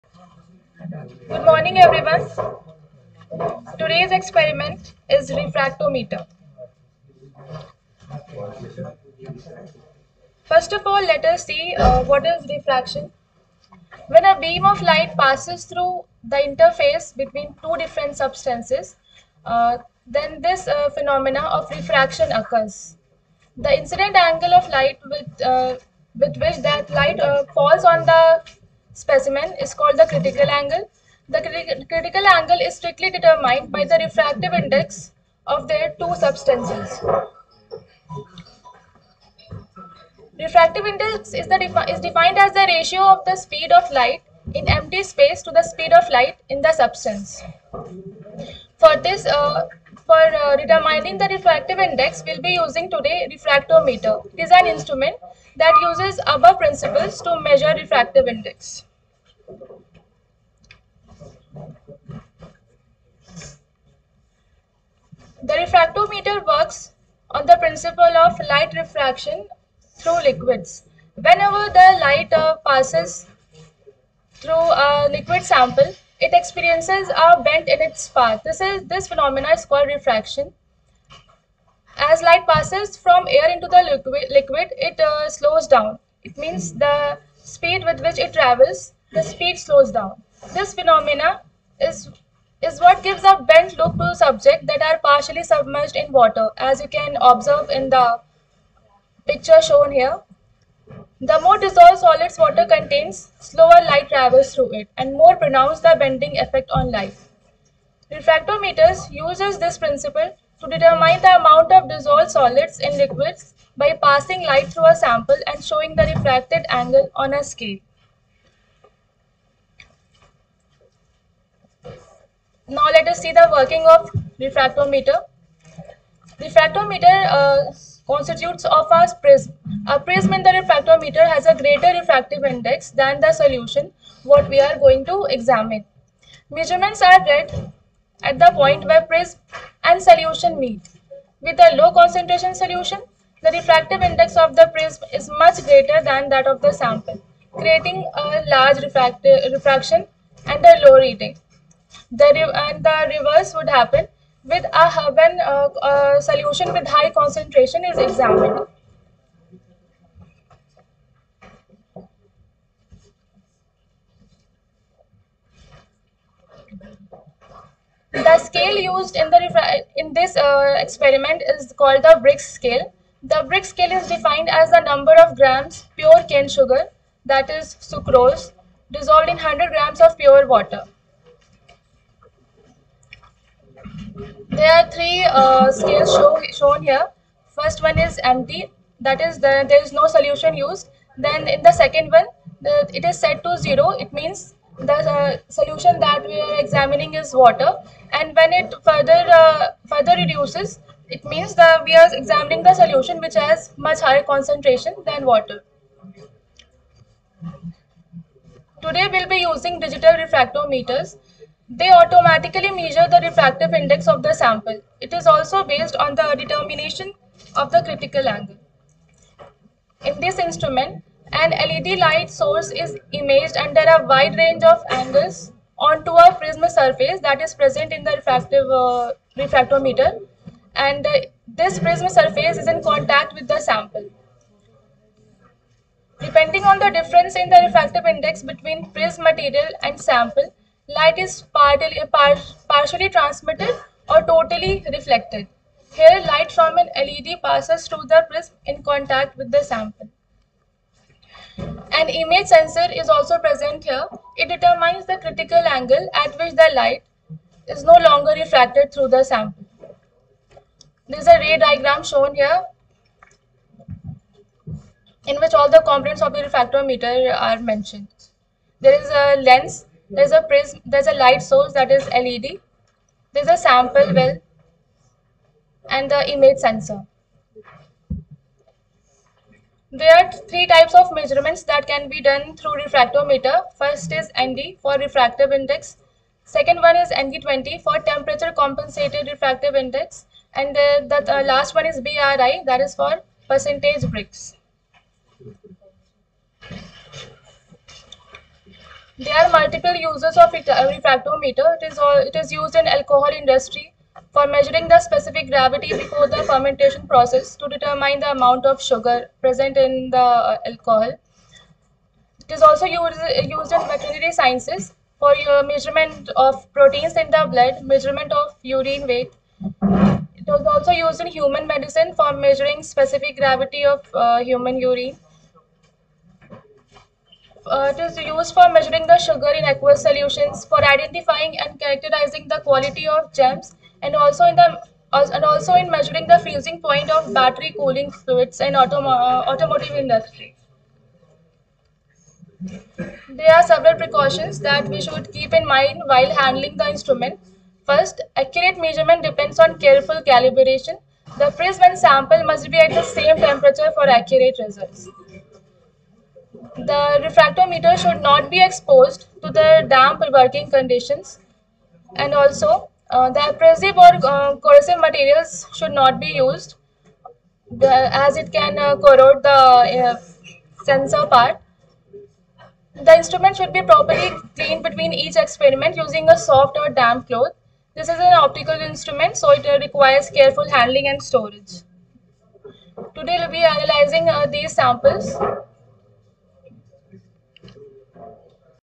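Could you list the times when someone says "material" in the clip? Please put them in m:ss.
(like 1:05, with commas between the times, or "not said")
3:59, 6:05.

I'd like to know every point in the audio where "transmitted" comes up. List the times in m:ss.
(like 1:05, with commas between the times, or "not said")
4:03.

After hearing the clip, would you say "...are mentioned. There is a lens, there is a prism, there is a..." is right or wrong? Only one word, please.
right.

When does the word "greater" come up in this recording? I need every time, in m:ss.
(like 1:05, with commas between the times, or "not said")
2:11, 2:25.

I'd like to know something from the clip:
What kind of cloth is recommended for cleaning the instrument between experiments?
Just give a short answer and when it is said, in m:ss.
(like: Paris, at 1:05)
soft or damp cloth, at 6:16.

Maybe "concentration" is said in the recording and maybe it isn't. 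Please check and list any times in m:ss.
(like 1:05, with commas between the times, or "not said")
2:21, 2:37, 3:24.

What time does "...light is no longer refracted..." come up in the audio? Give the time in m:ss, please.
4:16.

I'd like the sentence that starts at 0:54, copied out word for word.
It is an instrument that uses above principles to measure refractive index.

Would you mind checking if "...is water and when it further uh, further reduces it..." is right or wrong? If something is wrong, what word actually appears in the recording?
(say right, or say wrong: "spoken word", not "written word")
right.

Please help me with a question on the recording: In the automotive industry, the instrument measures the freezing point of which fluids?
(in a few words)
battery cooling fluids.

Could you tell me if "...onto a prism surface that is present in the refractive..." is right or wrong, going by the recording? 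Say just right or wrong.
right.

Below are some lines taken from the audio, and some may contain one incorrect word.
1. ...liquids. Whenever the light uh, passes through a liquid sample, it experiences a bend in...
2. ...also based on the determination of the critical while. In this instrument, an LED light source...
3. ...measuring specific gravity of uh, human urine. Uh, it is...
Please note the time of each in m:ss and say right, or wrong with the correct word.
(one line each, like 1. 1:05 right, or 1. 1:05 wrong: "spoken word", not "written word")
1. 1:10 right
2. 3:35 wrong: "angle", not "while"
3. 5:22 right.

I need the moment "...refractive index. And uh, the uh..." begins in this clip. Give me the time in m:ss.
4:49.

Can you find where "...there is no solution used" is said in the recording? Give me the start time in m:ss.
3:09.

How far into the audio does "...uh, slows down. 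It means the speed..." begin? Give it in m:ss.
1:24.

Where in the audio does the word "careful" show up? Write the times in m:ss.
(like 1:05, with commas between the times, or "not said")
5:49, 6:20.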